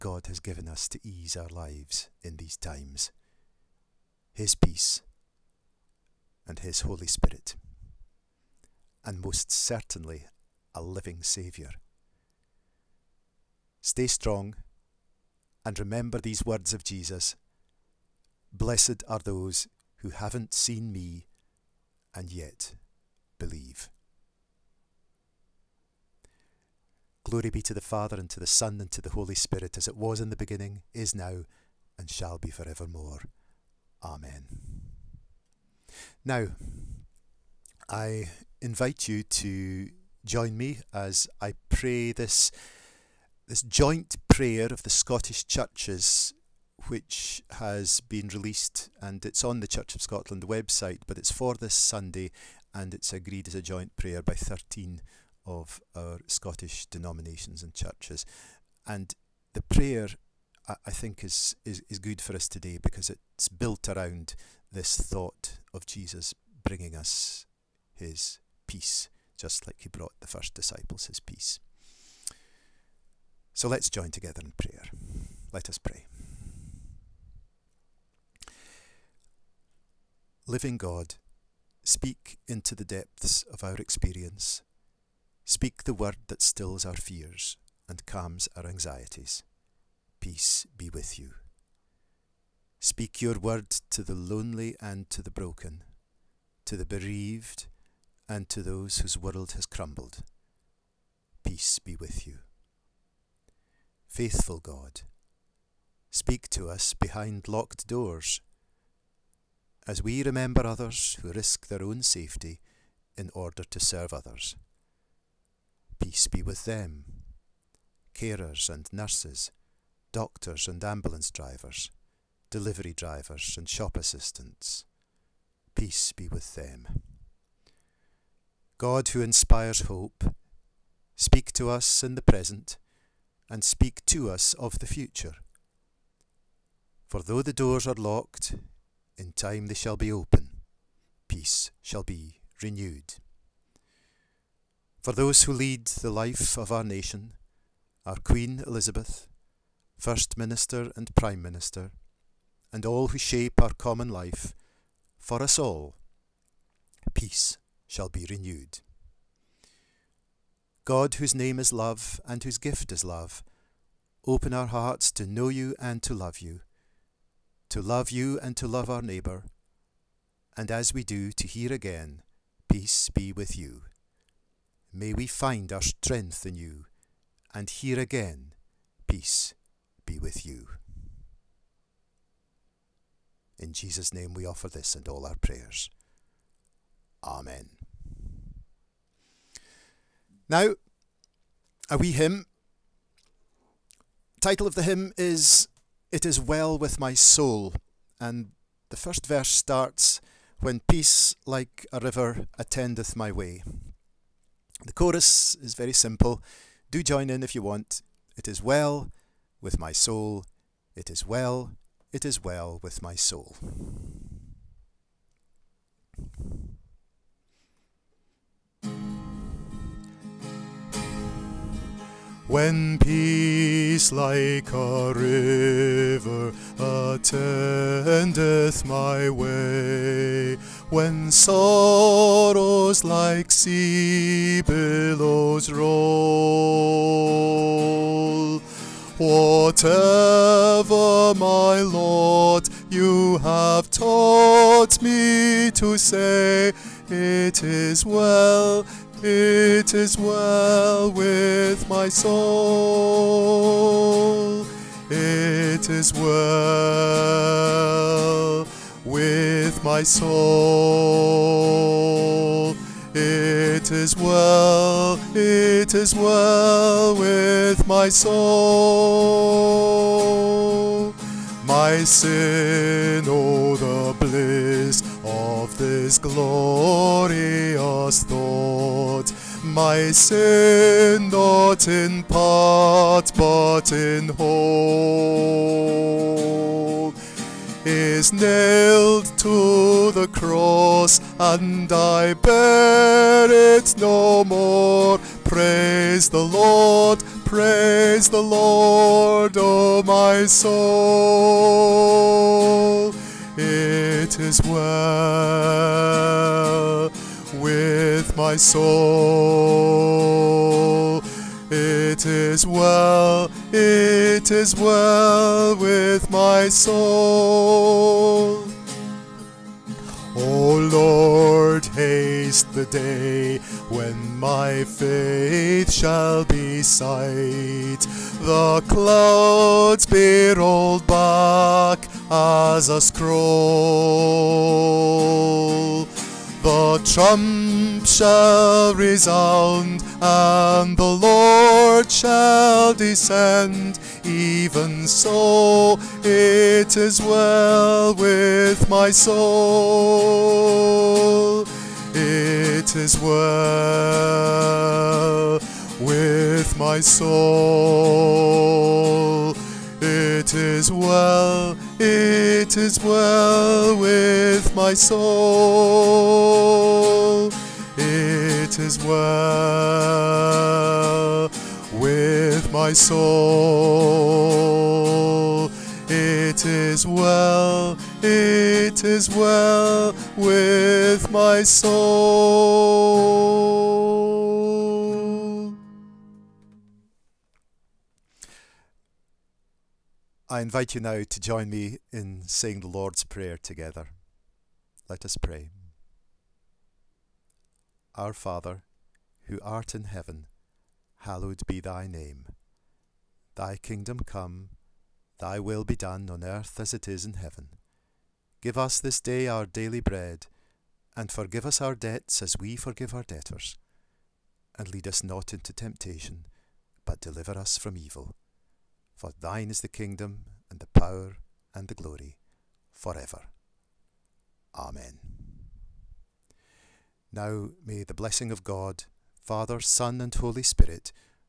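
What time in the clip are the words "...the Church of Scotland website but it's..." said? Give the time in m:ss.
0:49.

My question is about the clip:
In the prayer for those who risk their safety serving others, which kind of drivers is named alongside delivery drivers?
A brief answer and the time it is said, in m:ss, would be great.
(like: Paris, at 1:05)
Ambulance drivers, at 2:00.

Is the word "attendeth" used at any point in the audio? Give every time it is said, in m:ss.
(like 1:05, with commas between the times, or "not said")
3:22, 3:46.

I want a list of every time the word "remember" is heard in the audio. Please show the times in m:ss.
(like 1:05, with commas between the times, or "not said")
0:15, 1:50.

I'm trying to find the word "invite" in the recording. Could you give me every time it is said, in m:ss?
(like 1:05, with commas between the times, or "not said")
0:38, 6:30.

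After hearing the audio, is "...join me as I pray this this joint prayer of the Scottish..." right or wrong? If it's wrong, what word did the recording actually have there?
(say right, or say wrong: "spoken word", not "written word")
right.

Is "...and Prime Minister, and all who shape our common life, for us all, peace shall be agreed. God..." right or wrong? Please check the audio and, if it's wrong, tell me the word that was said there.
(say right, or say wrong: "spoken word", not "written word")
wrong: "renewed", not "agreed".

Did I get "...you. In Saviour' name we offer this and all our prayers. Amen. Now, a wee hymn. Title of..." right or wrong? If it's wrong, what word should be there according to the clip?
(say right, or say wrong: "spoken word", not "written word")
wrong: "Jesus", not "Saviour".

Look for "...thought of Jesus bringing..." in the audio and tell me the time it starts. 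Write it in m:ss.
1:04.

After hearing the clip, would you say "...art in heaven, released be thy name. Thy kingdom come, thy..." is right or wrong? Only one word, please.
wrong.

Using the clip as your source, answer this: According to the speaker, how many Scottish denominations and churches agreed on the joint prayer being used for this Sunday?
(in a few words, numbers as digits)
13.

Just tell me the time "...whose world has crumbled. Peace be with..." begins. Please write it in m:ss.
1:38.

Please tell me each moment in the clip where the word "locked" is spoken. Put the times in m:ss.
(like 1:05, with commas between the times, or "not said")
1:47, 2:17.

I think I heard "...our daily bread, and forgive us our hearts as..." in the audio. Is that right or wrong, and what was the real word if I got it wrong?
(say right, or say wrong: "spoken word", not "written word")
wrong: "debts", not "hearts".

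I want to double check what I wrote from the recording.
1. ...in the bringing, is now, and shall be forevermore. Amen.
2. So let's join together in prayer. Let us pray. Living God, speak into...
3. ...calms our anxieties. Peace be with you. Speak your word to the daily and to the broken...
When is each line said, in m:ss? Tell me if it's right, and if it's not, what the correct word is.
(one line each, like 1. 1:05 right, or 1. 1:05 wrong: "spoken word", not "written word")
1. 0:30 wrong: "beginning", not "bringing"
2. 1:13 right
3. 1:28 wrong: "lonely", not "daily".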